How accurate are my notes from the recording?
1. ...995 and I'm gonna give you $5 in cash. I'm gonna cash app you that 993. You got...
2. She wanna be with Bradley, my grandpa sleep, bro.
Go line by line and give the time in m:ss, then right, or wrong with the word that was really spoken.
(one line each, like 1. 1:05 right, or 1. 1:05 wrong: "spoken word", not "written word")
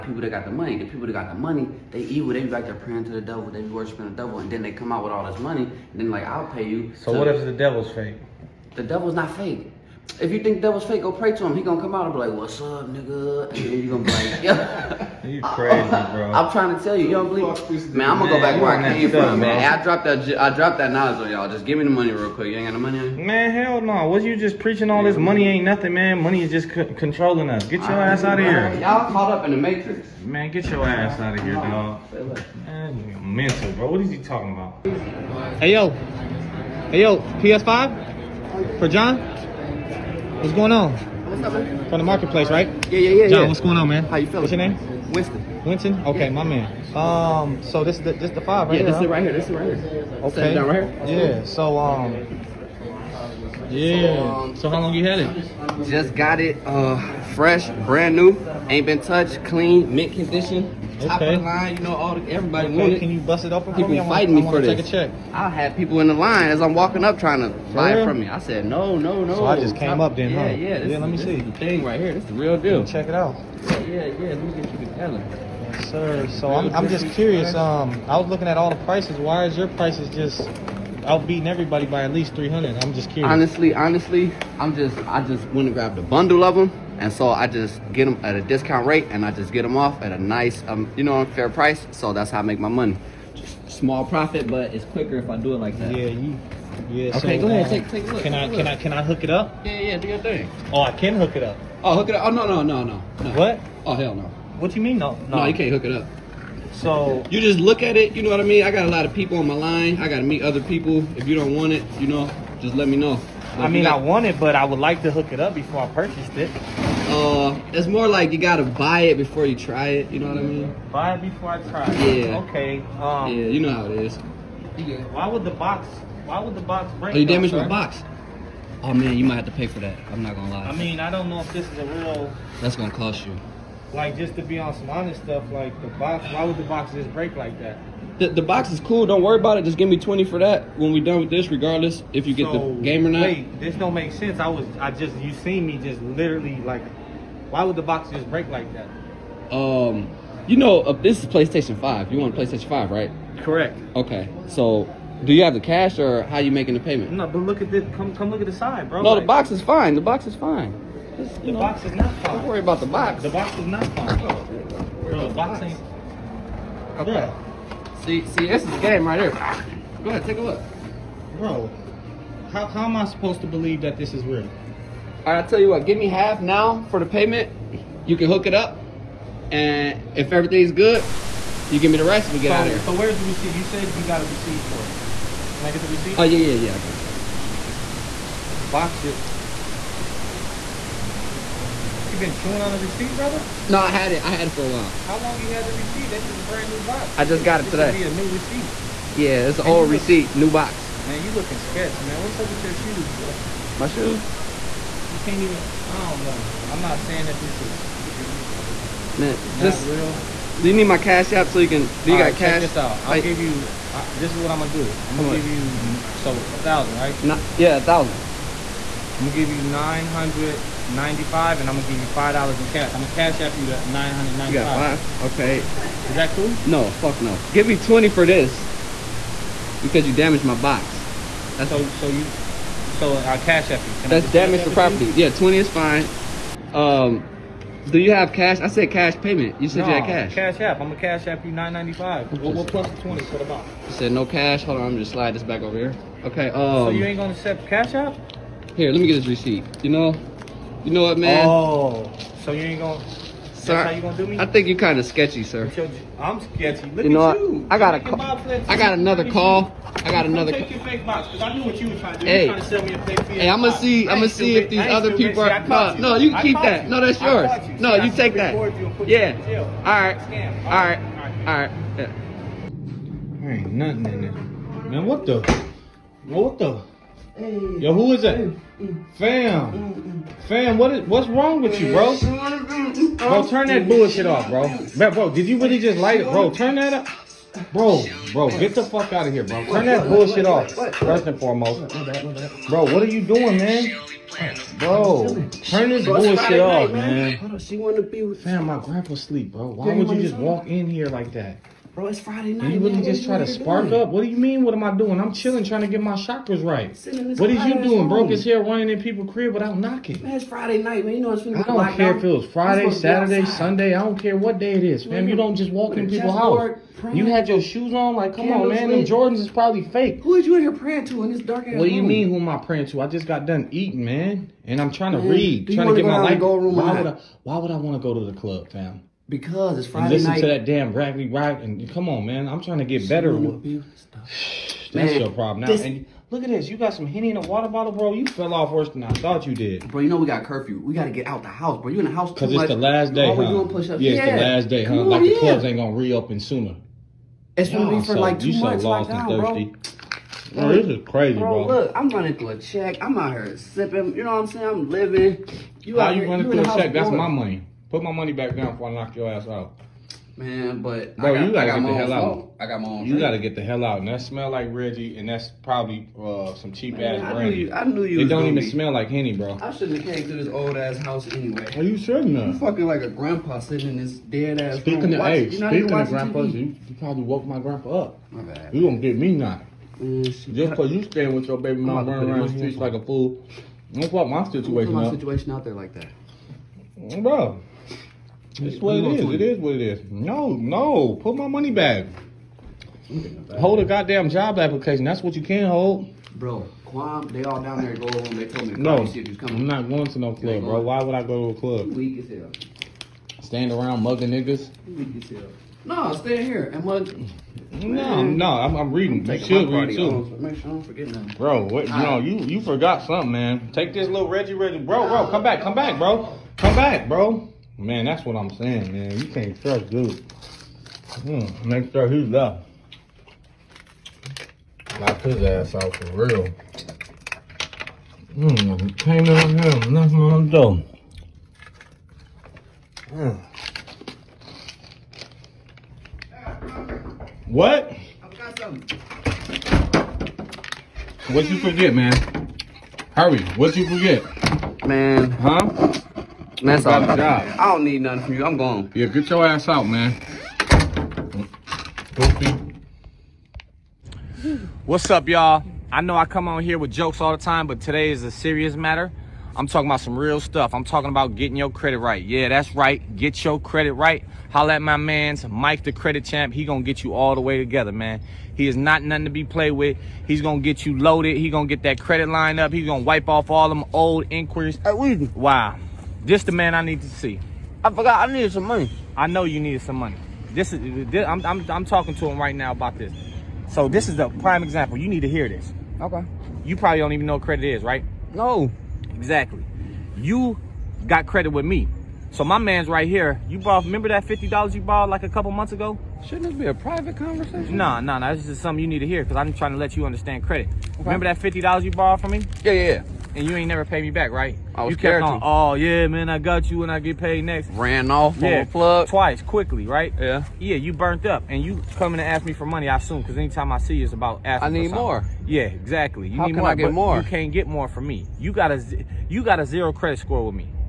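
1. 3:39 wrong: "995", not "993"
2. 4:57 wrong: "Fam", not "Bradley".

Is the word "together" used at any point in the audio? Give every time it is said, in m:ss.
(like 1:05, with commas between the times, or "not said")
1:14, 7:47.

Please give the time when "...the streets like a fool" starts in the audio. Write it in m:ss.
6:22.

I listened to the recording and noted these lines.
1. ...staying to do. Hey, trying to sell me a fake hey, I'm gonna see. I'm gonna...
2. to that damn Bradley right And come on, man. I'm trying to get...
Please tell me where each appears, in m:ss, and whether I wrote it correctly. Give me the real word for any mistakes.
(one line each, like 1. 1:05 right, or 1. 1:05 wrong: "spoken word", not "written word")
1. 4:21 wrong: "trying", not "staying"
2. 5:30 right.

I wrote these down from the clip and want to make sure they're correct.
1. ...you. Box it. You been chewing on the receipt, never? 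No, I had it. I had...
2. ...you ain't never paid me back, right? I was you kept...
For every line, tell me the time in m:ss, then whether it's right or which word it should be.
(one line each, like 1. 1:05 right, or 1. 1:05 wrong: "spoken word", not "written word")
1. 3:08 wrong: "brother", not "never"
2. 8:23 right.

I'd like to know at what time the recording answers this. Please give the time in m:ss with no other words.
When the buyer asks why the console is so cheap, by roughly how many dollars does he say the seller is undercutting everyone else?
1:22.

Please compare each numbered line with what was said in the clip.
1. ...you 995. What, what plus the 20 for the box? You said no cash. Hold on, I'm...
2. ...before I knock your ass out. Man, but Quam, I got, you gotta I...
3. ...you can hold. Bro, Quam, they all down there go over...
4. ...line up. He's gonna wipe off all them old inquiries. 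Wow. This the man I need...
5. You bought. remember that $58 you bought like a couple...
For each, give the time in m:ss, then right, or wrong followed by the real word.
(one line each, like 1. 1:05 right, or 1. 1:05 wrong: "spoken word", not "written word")
1. 4:01 right
2. 5:58 wrong: "Bro", not "Quam"
3. 6:35 right
4. 7:52 right
5. 8:13 wrong: "50", not "58".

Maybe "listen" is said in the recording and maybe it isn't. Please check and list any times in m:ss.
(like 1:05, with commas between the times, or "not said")
5:30.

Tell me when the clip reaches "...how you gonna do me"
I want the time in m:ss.
4:13.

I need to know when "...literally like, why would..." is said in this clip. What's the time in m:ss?
2:26.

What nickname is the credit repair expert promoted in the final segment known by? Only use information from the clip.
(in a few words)
Mike the Credit Champ.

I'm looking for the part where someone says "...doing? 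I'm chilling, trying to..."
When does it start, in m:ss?
5:04.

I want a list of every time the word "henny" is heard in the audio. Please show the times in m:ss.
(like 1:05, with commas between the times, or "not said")
5:37, 6:09.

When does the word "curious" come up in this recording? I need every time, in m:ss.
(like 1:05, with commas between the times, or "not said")
1:17, 1:23.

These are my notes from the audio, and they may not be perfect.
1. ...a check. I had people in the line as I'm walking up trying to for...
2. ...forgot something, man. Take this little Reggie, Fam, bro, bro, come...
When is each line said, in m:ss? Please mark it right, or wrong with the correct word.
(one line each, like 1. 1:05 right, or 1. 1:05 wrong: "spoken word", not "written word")
1. 1:04 right
2. 6:52 wrong: "Reggie", not "Fam".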